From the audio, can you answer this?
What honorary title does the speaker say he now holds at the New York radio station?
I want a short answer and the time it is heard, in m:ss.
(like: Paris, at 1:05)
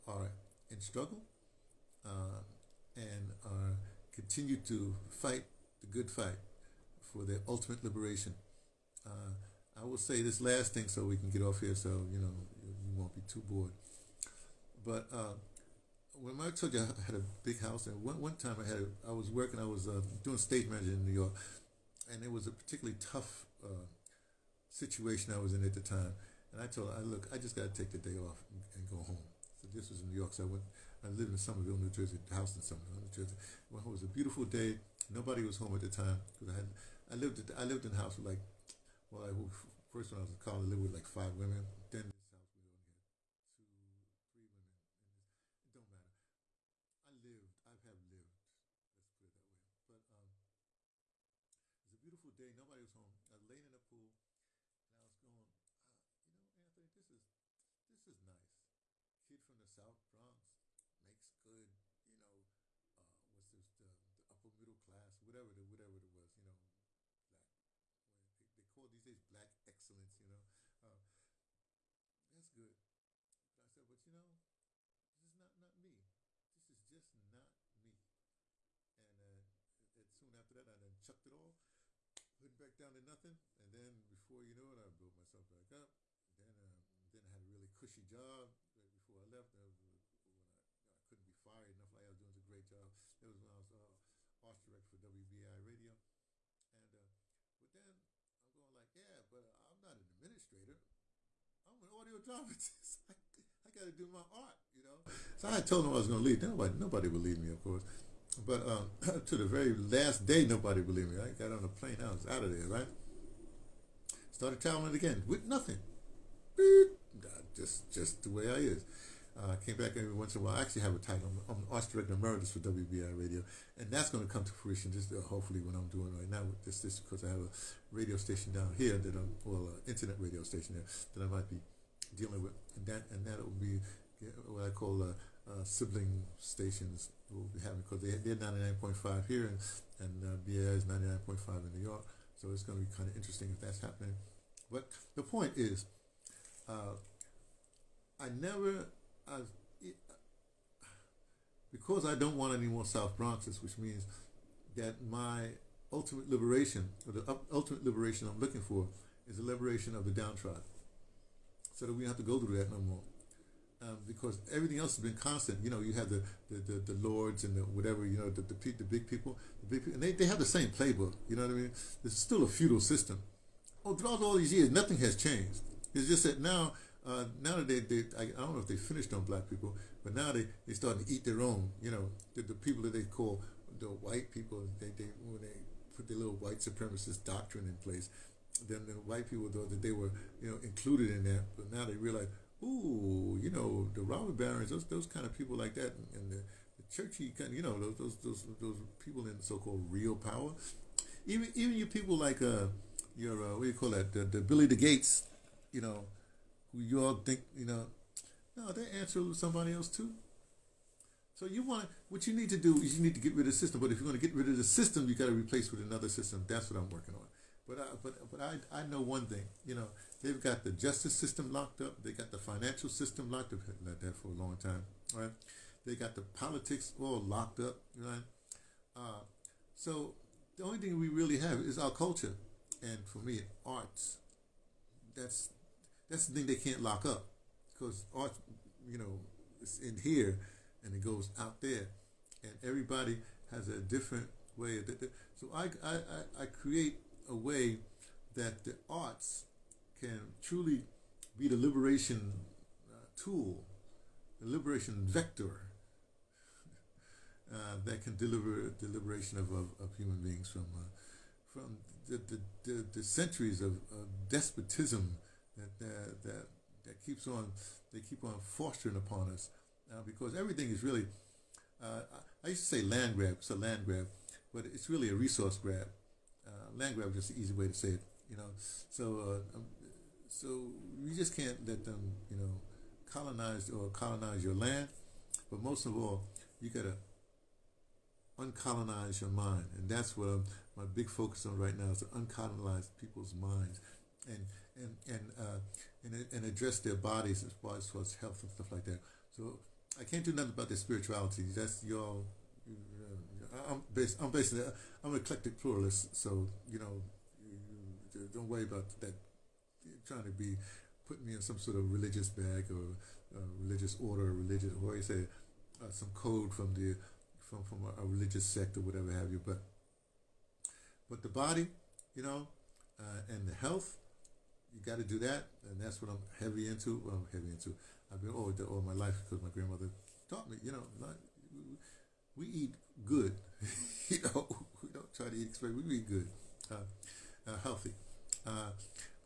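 Arts Director Emeritus, at 2:01.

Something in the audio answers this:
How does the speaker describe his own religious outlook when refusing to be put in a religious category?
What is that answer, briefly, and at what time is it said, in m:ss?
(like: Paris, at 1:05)
Eclectic pluralist, at 5:05.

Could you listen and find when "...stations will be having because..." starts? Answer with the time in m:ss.
2:16.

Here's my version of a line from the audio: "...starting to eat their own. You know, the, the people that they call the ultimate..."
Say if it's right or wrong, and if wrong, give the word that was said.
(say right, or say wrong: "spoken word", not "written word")
wrong: "white", not "ultimate".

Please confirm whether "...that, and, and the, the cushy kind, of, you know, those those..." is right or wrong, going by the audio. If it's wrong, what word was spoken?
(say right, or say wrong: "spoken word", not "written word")
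wrong: "churchy", not "cushy".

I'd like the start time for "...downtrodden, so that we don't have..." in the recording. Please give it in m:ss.
2:40.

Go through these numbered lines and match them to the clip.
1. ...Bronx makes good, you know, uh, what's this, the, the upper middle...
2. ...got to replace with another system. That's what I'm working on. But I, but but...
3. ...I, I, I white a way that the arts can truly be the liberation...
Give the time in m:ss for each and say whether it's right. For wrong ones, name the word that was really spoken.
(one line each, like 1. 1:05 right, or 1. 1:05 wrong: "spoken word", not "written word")
1. 1:00 right
2. 3:35 right
3. 4:05 wrong: "create", not "white".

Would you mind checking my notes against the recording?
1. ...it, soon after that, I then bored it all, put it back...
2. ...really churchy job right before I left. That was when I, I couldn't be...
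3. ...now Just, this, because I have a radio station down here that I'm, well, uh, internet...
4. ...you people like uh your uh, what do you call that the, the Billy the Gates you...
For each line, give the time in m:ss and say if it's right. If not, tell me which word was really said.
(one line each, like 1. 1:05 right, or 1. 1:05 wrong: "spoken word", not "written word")
1. 1:19 wrong: "chucked", not "bored"
2. 1:27 wrong: "cushy", not "churchy"
3. 2:06 right
4. 3:21 right.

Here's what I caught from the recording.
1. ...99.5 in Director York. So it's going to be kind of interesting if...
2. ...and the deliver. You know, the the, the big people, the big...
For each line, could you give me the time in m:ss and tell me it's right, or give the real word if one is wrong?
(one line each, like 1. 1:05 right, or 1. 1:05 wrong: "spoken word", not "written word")
1. 2:20 wrong: "New", not "Director"
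2. 2:47 wrong: "whatever", not "deliver".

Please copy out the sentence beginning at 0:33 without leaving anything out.
Well, it was a beautiful day.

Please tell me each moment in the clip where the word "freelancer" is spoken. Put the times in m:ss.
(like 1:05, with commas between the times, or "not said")
not said.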